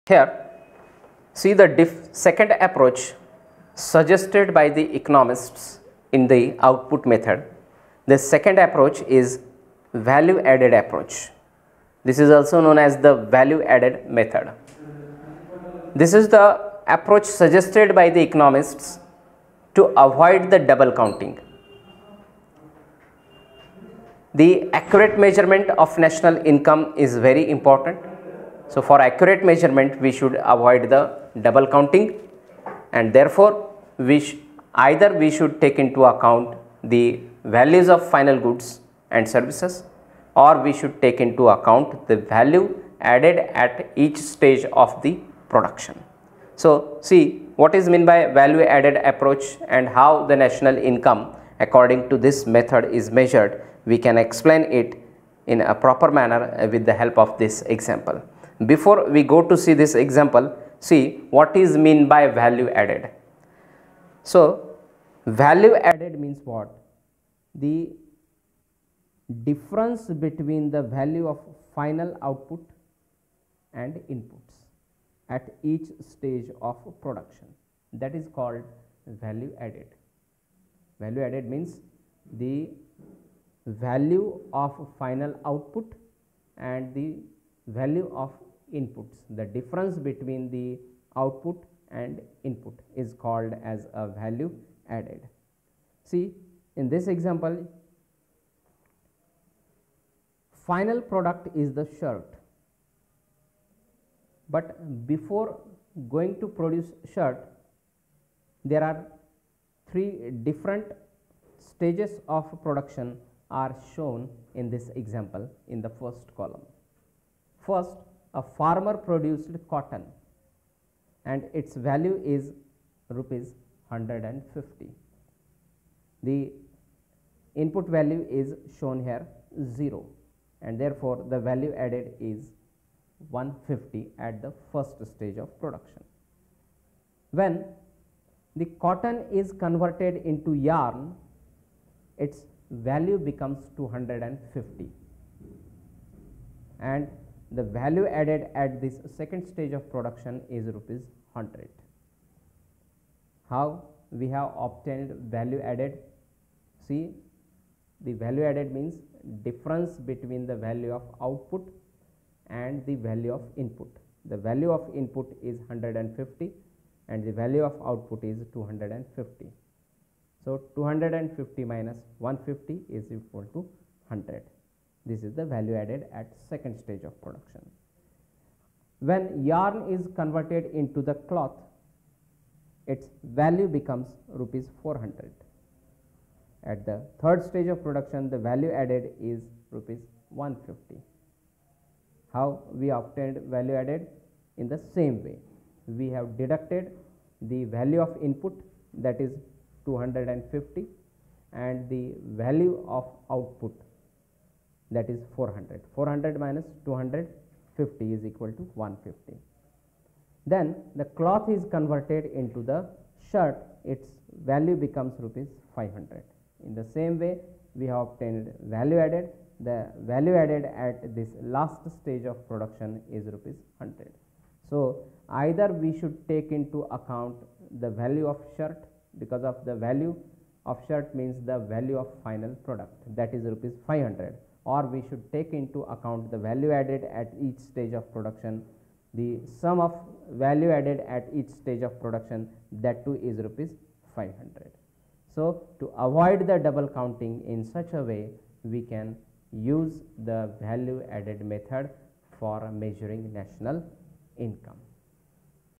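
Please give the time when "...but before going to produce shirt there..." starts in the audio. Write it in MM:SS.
01:44.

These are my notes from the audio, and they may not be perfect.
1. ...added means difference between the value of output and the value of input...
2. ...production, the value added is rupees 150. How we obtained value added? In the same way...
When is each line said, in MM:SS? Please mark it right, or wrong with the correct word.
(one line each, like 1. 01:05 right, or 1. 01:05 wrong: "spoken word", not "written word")
1. 02:38 right
2. 03:07 right.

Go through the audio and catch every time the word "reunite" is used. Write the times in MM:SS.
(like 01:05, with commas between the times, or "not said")
not said.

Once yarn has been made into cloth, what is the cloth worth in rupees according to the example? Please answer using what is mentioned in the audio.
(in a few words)
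400.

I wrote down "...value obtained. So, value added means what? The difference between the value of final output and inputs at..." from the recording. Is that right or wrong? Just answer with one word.
wrong.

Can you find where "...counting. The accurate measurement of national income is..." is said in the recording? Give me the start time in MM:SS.
00:20.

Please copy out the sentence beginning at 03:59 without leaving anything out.
The sum of value added at each stage of production that too is rupees 500.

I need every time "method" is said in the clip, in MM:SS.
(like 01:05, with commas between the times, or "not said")
00:07, 00:14, 00:52, 04:11.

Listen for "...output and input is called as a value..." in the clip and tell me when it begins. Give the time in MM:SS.
01:31.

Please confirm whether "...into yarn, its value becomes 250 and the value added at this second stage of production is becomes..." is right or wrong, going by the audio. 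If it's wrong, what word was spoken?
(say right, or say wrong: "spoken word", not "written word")
wrong: "rupees", not "becomes".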